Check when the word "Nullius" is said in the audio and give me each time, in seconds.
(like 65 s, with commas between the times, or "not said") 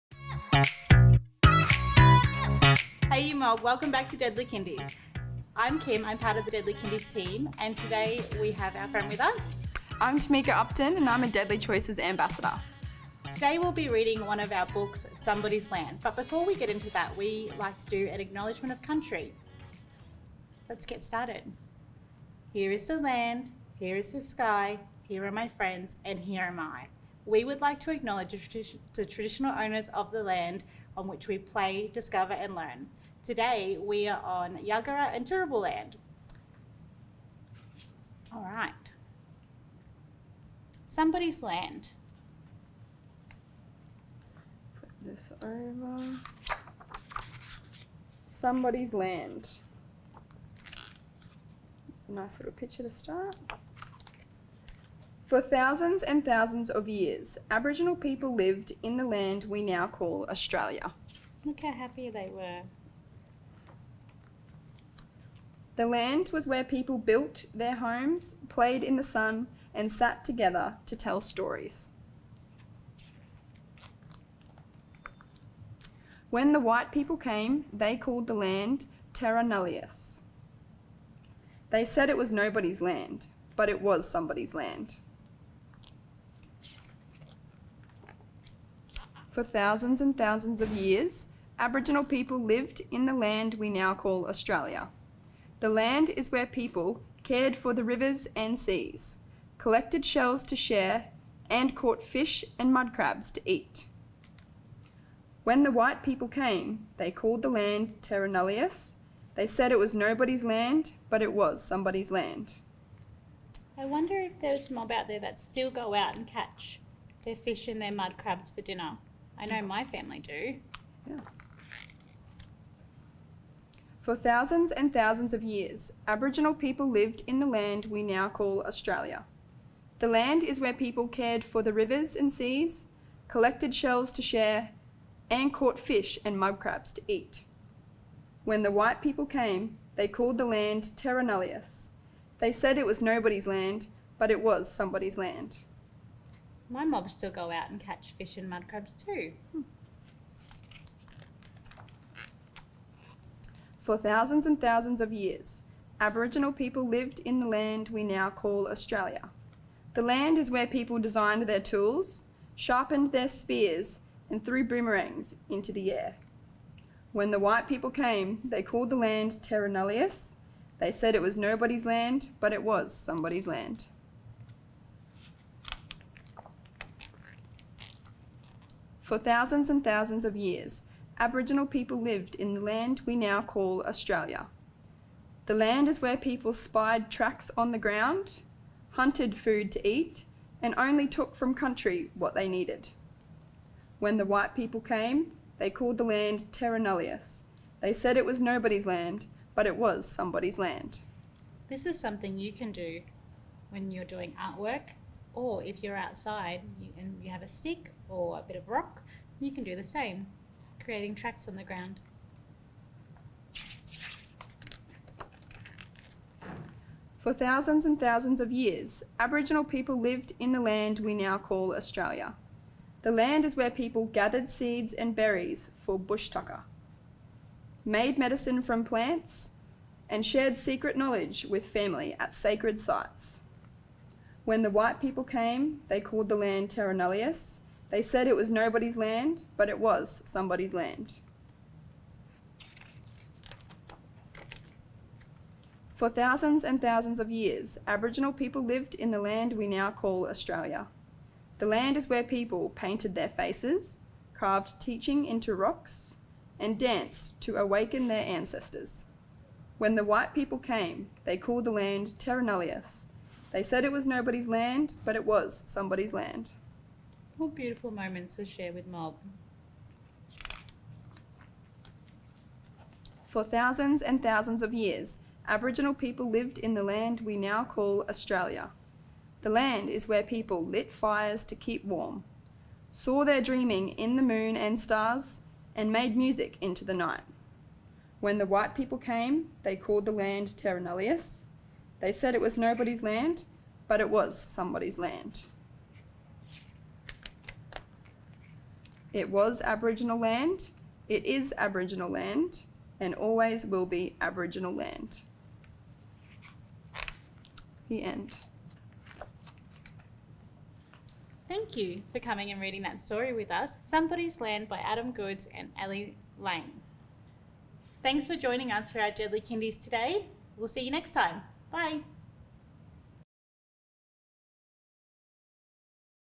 79 s, 108 s, 141 s, 169 s, 196 s, 236 s, 262 s, 290 s.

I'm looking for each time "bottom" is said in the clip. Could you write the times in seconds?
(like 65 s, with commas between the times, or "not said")
not said.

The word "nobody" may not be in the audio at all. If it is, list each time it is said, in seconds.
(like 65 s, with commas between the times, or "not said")
82 s, 109 s, 143 s, 171 s, 198 s, 238 s, 264 s, 292 s.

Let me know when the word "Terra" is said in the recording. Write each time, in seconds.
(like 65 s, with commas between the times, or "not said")
79 s, 108 s, 140 s, 169 s, 196 s, 236 s, 262 s.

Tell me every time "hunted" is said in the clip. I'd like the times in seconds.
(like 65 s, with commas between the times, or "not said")
188 s.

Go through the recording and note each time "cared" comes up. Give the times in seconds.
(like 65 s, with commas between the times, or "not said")
97 s, 131 s.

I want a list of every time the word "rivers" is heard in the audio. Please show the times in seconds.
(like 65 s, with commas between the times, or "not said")
97 s, 131 s.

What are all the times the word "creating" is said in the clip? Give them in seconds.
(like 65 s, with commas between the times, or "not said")
210 s.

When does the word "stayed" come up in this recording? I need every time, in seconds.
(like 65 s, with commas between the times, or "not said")
not said.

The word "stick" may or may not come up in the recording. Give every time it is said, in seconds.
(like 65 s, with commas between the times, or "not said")
207 s.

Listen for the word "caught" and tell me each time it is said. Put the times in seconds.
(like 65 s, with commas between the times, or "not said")
101 s, 135 s.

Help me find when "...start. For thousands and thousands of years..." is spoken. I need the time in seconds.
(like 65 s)
52 s.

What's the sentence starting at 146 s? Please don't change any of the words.
My mob still go out and catch fish and mud crabs too.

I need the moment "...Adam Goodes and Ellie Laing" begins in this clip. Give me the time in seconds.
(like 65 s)
314 s.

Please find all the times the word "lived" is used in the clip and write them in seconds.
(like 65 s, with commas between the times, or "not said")
58 s, 92 s, 126 s, 156 s, 182 s, 219 s, 248 s, 276 s.